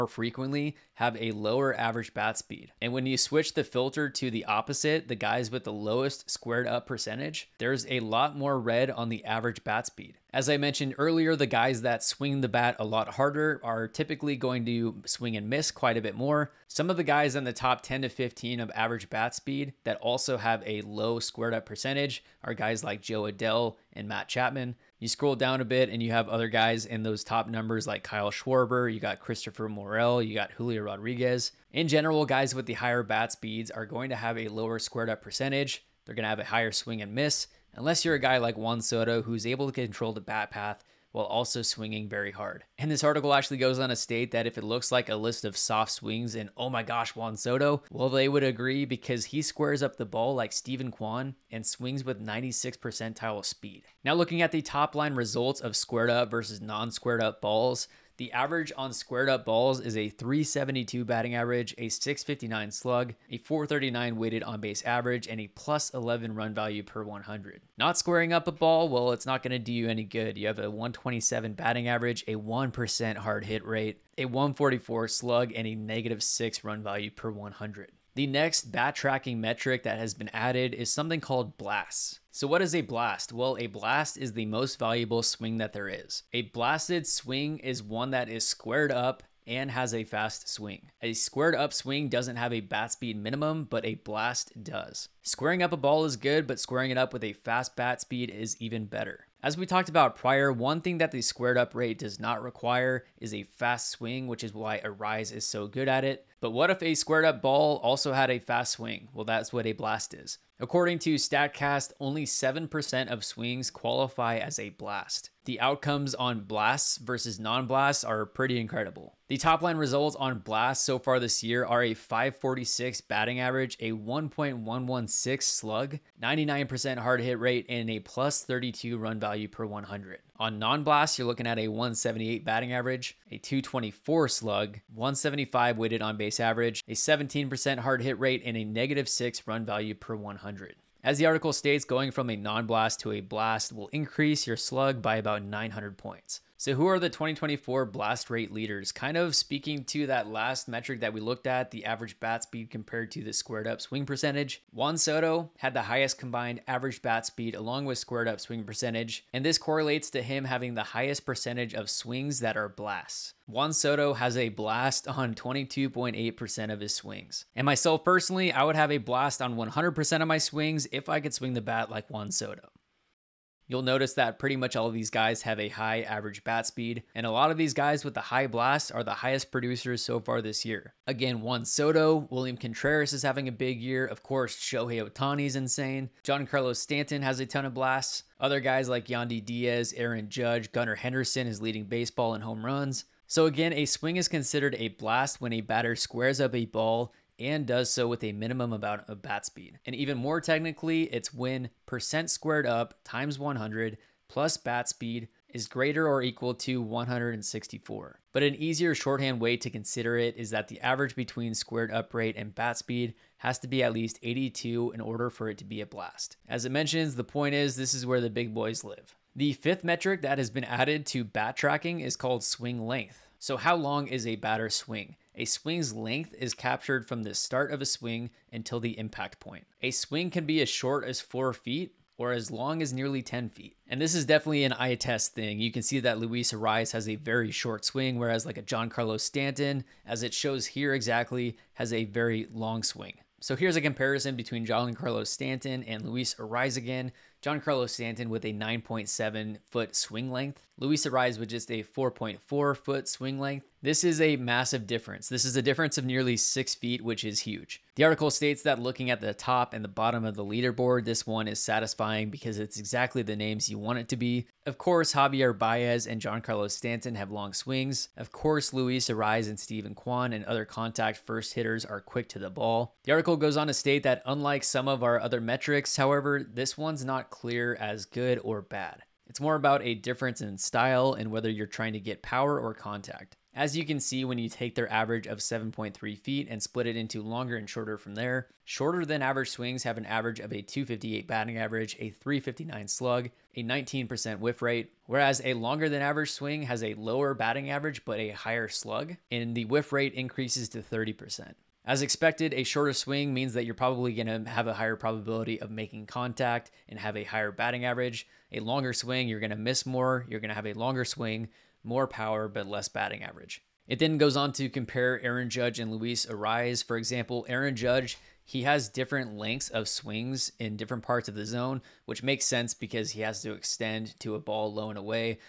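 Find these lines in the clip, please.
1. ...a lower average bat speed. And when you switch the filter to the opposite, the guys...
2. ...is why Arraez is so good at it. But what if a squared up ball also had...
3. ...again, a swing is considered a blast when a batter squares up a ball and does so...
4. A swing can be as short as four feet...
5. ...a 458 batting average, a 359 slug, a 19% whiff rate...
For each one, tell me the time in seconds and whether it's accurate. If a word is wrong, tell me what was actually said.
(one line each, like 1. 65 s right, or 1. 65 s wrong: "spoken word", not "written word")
1. 1 s right
2. 104 s right
3. 193 s right
4. 229 s right
5. 290 s wrong: "258", not "458".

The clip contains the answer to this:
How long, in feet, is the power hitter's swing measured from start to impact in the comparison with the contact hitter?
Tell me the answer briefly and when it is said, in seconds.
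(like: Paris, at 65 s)
9.7 feet, at 248 s.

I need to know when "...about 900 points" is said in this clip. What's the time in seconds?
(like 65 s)
145 s.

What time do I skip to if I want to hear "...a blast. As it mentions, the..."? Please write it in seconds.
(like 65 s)
215 s.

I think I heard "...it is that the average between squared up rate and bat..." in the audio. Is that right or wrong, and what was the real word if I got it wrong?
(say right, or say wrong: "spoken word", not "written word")
right.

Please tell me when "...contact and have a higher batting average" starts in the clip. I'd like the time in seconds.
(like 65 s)
306 s.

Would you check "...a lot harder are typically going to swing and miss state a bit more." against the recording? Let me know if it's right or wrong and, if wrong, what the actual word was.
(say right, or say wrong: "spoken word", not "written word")
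wrong: "quite", not "state".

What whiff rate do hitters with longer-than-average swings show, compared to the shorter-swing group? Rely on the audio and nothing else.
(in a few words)
30%.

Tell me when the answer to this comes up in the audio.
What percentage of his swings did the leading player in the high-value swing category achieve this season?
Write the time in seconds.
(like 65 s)
165 s.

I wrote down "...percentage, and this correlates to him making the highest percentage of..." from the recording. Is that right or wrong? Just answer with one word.
wrong.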